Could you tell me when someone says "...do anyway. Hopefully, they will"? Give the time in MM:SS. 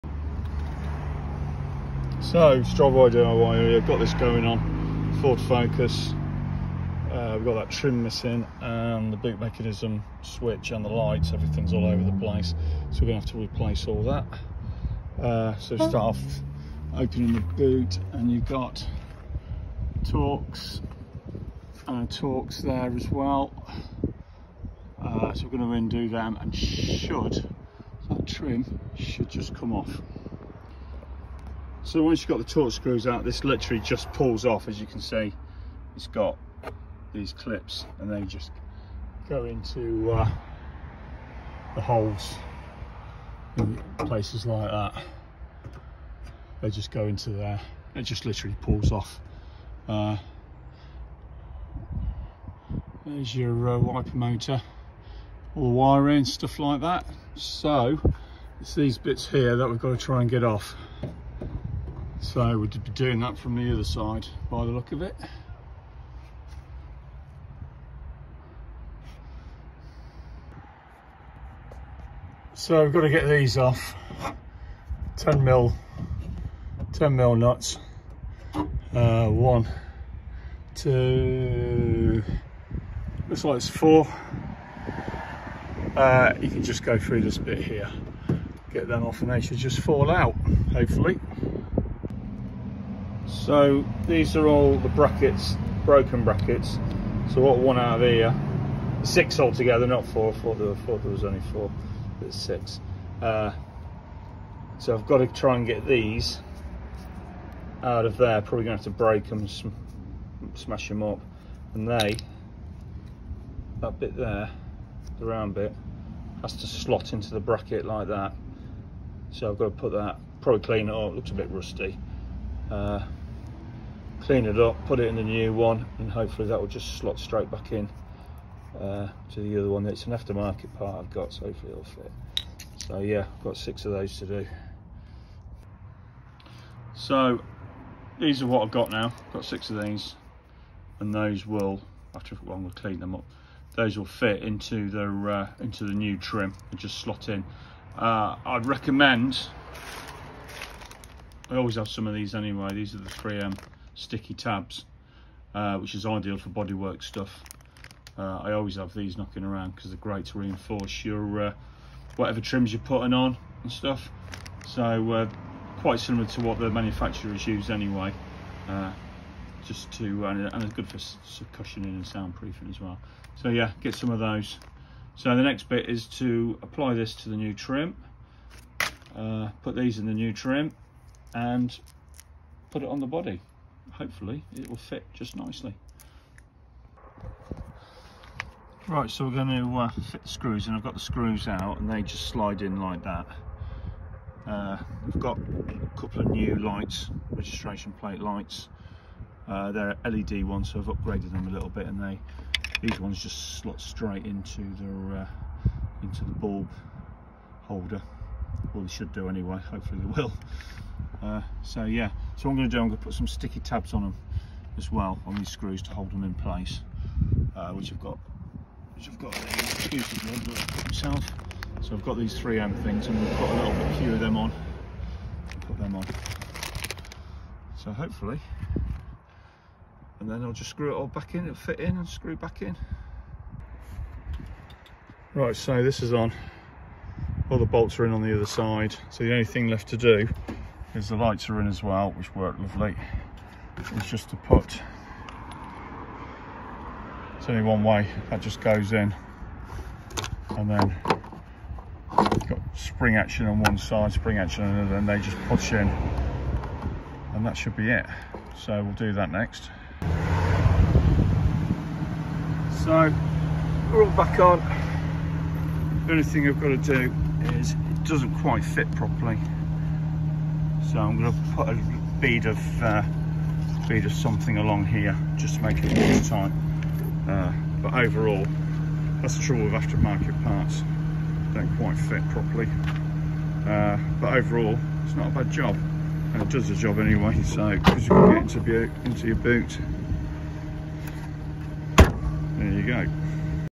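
03:29.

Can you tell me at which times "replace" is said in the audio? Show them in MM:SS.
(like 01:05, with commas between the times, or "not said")
00:13.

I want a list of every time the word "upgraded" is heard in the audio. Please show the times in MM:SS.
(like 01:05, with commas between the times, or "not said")
03:20.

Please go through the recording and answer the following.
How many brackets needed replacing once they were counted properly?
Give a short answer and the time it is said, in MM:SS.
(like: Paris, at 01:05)
6, at 01:39.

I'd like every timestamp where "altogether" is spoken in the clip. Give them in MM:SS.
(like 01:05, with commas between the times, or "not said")
01:39.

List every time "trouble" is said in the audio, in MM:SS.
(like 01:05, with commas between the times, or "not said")
04:39.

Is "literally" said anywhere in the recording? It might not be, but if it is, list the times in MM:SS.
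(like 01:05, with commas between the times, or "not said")
00:33, 00:48.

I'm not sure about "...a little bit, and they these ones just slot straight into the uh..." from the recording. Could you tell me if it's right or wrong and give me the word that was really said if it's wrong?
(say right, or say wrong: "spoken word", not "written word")
right.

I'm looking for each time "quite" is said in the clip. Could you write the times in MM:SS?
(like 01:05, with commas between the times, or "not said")
02:45, 04:28, 04:41.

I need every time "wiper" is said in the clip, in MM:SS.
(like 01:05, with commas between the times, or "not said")
00:53.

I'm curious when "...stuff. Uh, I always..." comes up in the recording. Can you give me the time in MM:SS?
02:37.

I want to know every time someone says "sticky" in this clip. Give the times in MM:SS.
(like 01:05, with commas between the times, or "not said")
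02:34, 03:33.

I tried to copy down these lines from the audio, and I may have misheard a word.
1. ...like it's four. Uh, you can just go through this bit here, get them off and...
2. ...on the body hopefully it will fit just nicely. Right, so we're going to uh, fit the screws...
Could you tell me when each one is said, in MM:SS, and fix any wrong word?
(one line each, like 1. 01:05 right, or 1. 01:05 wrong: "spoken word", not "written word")
1. 01:23 right
2. 03:02 right.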